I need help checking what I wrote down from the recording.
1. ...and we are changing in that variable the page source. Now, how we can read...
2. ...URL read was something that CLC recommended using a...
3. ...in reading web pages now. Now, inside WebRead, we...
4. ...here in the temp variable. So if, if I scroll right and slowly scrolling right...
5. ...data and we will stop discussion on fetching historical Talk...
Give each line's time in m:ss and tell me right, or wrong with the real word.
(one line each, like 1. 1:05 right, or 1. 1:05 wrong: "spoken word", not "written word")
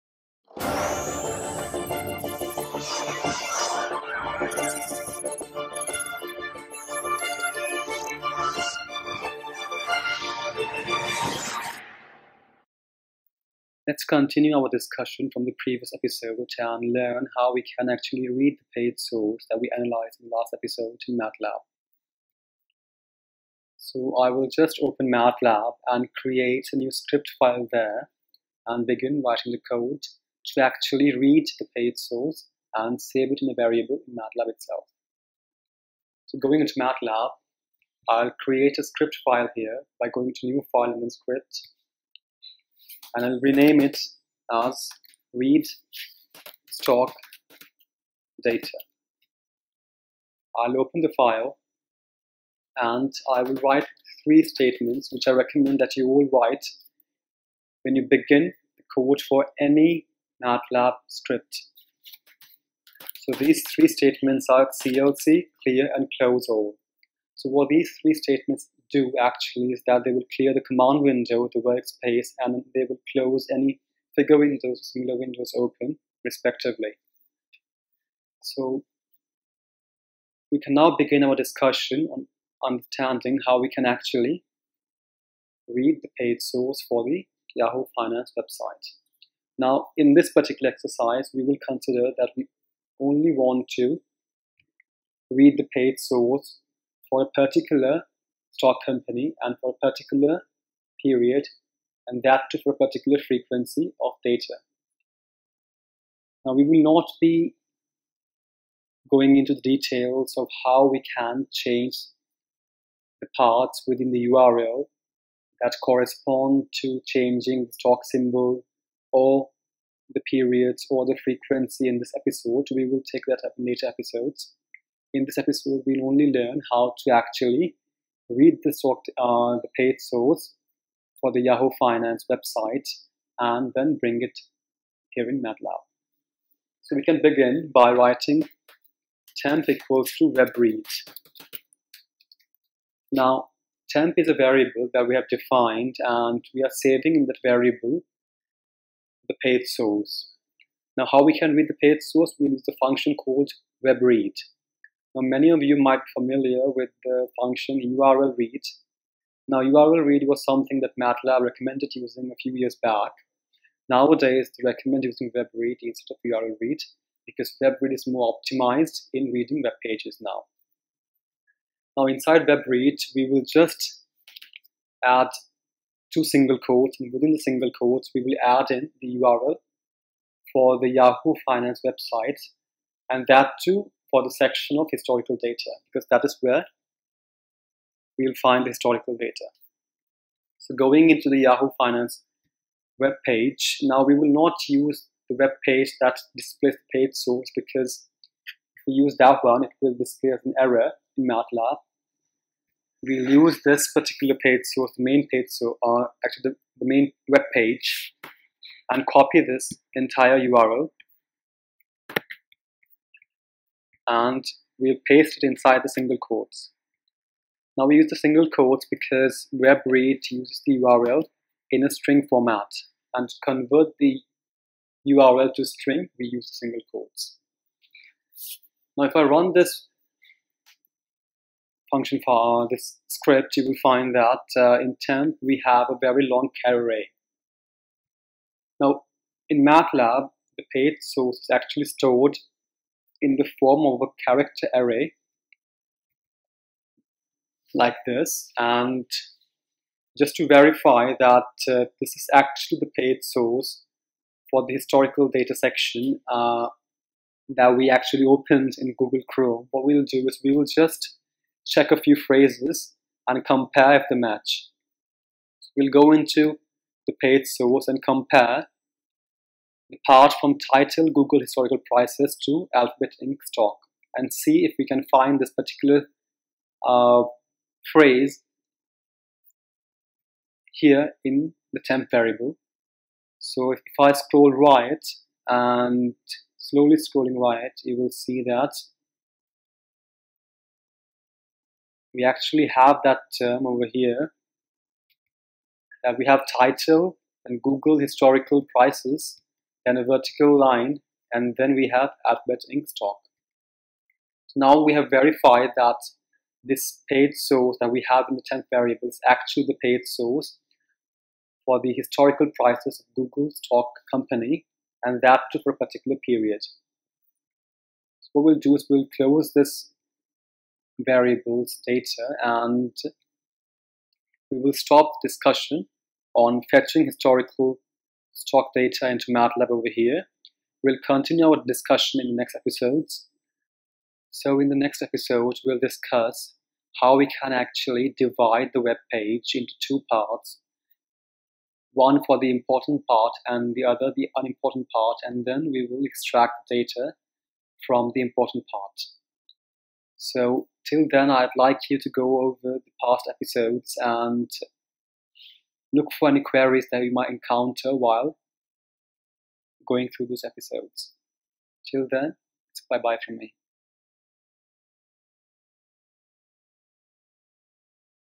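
1. 2:25 wrong: "saving", not "changing"
2. 2:39 wrong: "MATLAB", not "CLC"
3. 2:49 right
4. 4:40 right
5. 5:21 right.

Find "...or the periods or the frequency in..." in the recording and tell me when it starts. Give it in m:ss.
1:59.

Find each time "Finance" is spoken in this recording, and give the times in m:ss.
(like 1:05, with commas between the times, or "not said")
1:27, 2:11, 3:01, 3:11.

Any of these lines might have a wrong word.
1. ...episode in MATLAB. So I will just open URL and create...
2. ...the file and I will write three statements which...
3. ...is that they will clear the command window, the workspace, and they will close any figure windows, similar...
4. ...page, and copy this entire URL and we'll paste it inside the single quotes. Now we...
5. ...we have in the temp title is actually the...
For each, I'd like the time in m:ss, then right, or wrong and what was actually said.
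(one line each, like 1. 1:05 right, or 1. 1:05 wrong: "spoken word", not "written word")
1. 0:20 wrong: "MATLAB", not "URL"
2. 0:51 right
3. 1:09 right
4. 3:27 right
5. 5:07 wrong: "variable", not "title".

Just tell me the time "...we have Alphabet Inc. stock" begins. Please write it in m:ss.
5:01.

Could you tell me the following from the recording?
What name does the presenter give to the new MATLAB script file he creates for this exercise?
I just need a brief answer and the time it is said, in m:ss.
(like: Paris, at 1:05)
read stock data, at 0:45.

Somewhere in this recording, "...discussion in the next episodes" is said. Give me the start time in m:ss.
5:31.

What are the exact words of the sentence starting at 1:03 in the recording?
So these three statements are CLC, clear and close all.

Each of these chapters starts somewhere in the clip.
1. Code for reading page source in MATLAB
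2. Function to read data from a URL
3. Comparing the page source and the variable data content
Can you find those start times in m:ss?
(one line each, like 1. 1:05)
1. 0:52
2. 2:16
3. 4:09.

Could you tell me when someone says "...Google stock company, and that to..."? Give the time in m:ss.
5:13.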